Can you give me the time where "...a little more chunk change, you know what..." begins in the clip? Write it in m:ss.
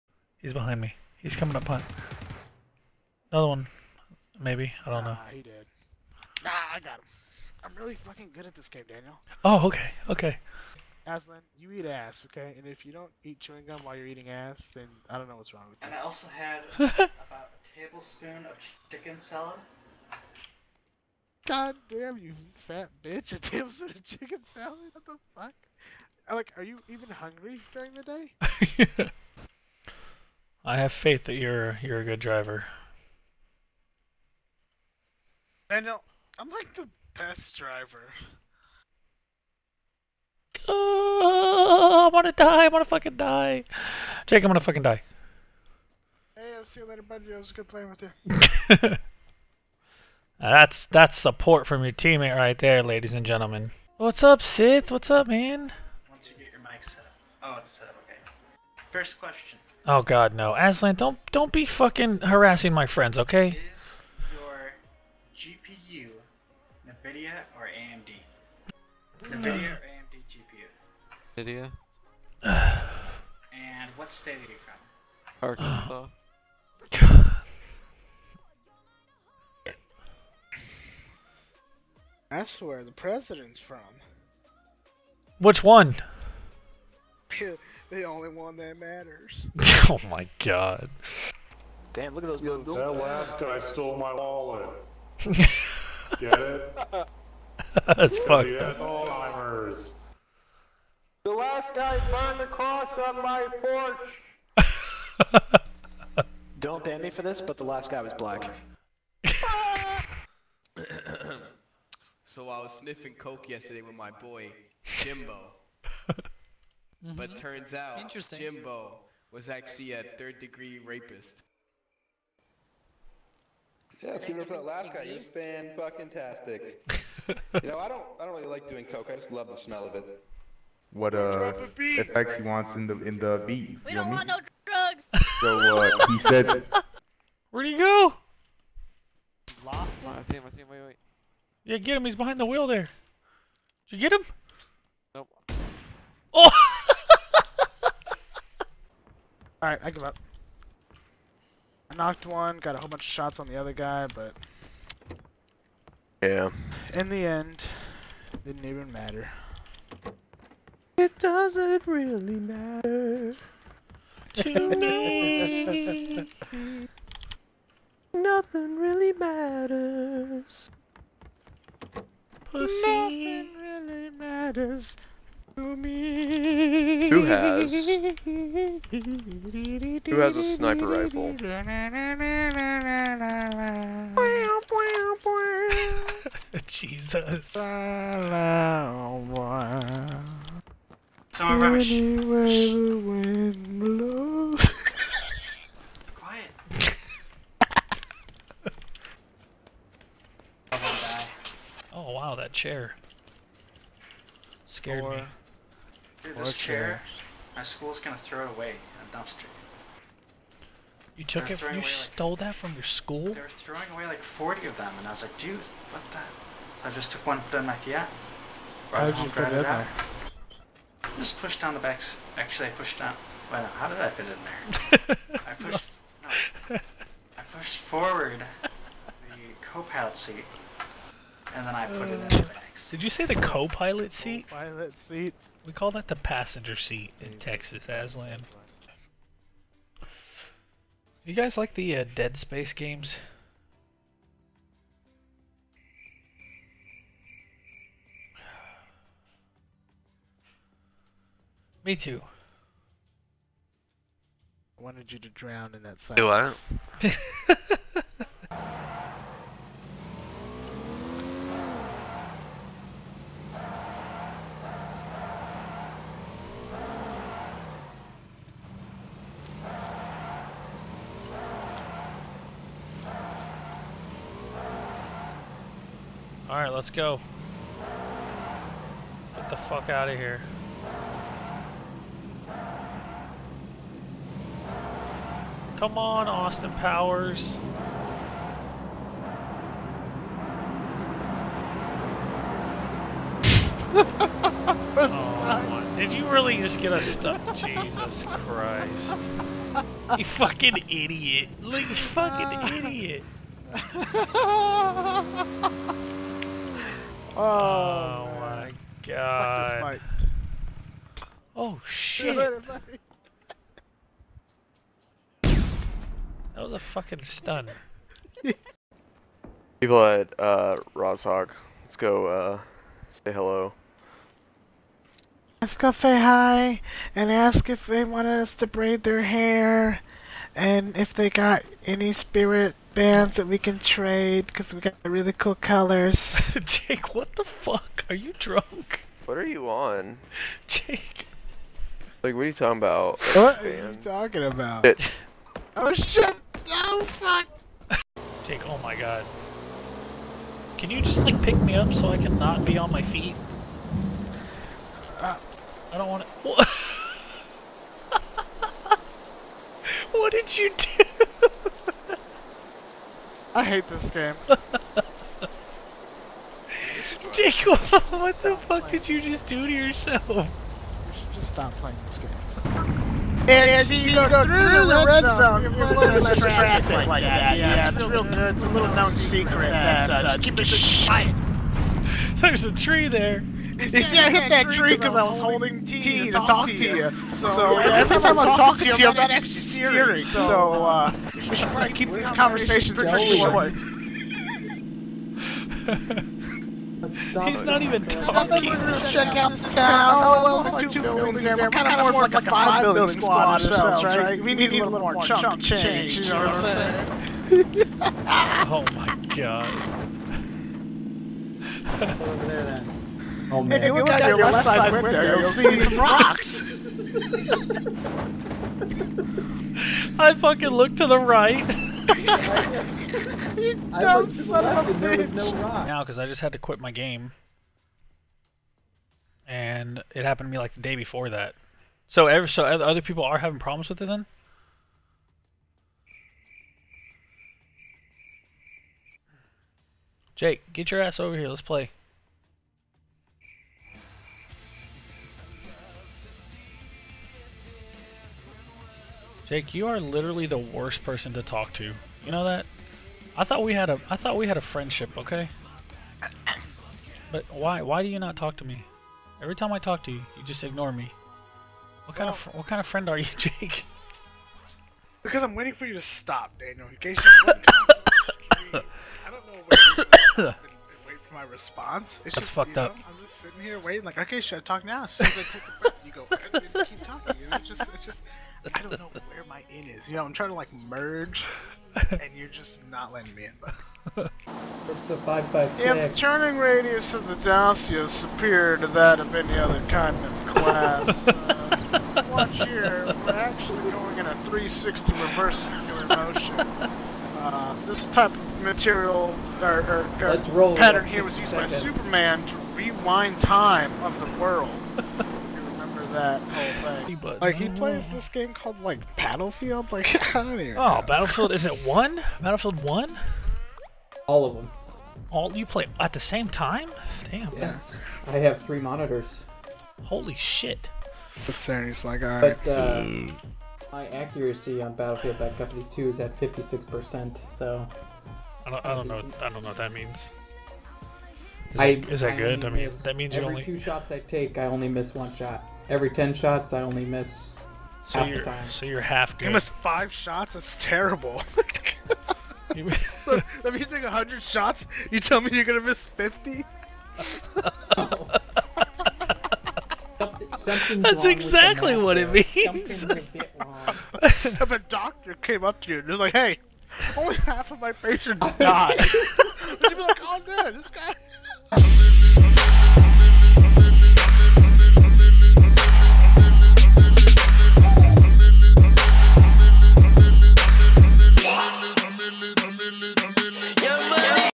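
6:44.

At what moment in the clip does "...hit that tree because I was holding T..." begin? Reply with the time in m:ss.
6:24.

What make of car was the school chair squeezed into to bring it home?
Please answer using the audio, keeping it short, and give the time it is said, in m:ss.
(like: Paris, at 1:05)
Fiat, at 3:37.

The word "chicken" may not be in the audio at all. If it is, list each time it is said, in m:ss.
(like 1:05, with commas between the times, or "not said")
0:18, 0:24.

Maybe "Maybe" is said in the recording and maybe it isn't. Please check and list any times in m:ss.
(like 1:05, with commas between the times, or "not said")
0:04.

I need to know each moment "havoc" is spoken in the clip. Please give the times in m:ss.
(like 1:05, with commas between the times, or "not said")
not said.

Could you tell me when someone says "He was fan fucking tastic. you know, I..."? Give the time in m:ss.
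2:05.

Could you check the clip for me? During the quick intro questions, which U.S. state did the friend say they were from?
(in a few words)
Arkansas.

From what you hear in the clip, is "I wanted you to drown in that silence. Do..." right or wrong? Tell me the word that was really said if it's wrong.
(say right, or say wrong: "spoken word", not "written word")
right.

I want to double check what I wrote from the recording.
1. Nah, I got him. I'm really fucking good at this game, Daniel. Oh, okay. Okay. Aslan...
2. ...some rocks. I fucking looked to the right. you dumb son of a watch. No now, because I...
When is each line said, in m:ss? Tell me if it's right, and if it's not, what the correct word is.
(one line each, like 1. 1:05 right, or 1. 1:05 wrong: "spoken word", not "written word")
1. 0:06 right
2. 6:55 wrong: "bitch", not "watch".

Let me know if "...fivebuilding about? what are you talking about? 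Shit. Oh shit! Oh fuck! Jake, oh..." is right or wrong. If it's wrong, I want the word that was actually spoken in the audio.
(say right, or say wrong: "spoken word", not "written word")
wrong: "talking", not "fivebuilding".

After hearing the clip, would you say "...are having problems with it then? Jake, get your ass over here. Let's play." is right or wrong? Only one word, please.
right.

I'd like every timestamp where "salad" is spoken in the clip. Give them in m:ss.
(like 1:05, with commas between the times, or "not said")
0:19, 0:24.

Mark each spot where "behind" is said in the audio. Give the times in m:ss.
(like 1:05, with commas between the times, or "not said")
0:00, 2:22.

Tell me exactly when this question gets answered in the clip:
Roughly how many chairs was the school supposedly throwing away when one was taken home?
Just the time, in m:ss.
3:34.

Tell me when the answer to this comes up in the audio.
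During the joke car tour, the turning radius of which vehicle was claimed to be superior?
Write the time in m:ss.
8:07.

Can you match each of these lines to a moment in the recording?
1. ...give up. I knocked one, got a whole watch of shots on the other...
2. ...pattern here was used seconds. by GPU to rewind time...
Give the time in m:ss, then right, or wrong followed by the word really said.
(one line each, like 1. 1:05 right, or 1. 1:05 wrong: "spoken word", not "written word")
1. 2:29 wrong: "bunch", not "watch"
2. 8:20 wrong: "Superman", not "GPU".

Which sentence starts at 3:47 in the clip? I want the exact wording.
I pushed forward the co-pilot seat, and then I put it in.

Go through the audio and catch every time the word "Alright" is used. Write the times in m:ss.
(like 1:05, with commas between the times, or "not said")
2:29, 4:36.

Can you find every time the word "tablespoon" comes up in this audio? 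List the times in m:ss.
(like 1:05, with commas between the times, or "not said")
0:17, 0:23.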